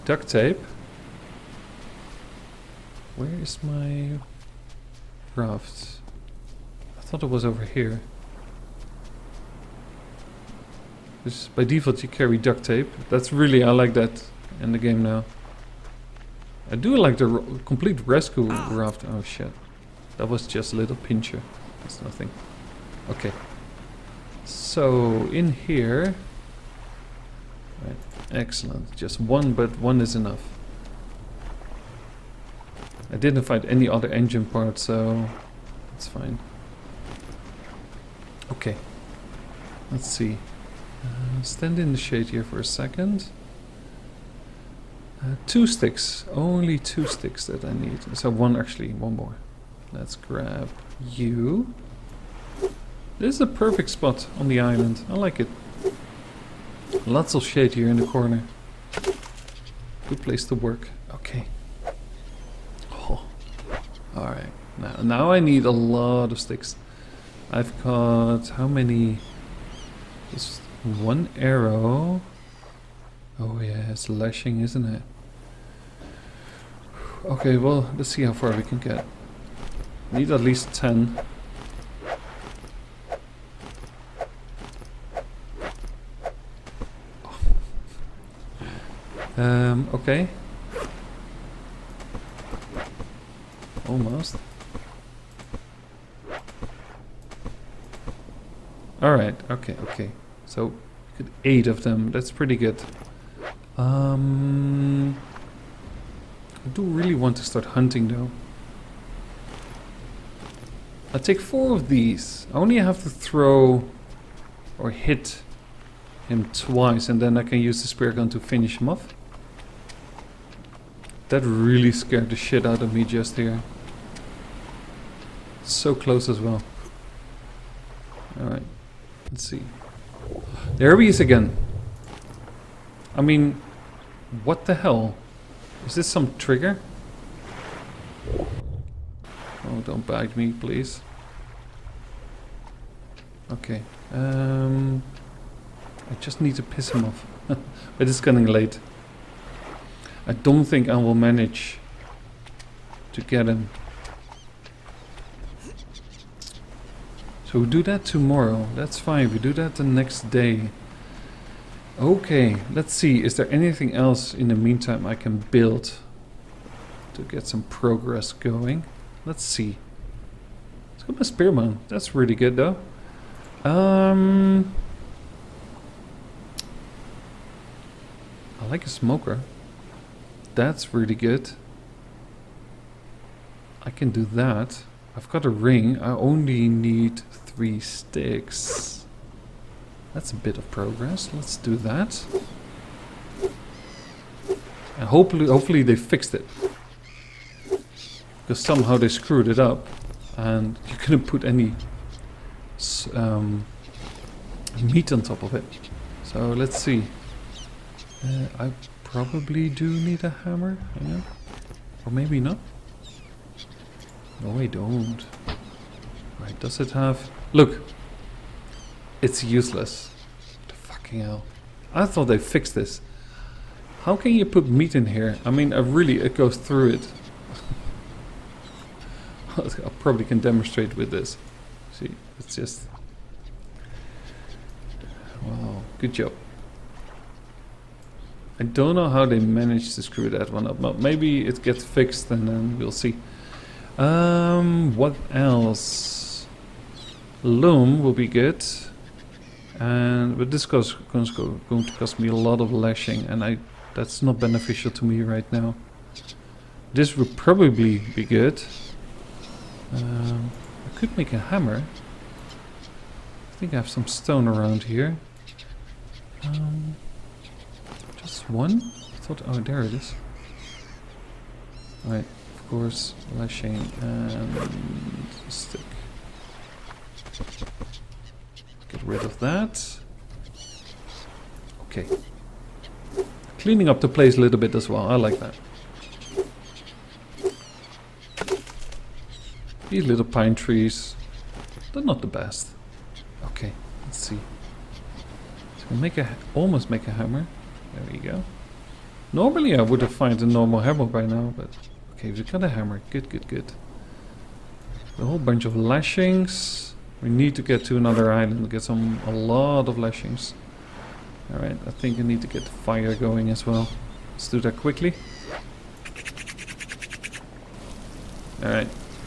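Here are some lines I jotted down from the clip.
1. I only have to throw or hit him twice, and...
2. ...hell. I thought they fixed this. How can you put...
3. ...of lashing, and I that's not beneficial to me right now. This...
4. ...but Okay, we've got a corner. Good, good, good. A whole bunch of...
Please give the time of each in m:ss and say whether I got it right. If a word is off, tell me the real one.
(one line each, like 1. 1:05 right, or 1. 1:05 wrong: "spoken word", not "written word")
1. 1:52 right
2. 3:41 right
3. 4:12 right
4. 5:01 wrong: "hammer", not "corner".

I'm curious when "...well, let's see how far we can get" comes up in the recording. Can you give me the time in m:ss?
1:17.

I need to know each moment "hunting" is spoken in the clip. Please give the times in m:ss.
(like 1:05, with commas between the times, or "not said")
1:47.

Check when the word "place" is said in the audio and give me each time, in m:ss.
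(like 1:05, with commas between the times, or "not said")
1:00, 4:44.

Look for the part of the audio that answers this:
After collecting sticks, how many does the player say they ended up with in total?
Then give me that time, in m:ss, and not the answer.
1:41.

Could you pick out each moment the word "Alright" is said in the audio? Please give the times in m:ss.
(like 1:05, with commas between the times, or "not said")
1:04, 1:39, 2:08, 4:32, 5:11, 5:18.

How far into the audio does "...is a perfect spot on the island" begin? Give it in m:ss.
0:53.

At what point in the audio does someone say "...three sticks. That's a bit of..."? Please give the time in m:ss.
3:07.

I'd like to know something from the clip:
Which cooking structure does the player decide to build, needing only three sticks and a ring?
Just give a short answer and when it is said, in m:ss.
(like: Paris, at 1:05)
smoker, at 2:58.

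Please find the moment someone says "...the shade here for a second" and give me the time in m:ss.
0:41.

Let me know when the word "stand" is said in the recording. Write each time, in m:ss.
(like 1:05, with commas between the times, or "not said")
0:41.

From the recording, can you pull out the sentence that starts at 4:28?
I thought, oh, there it is.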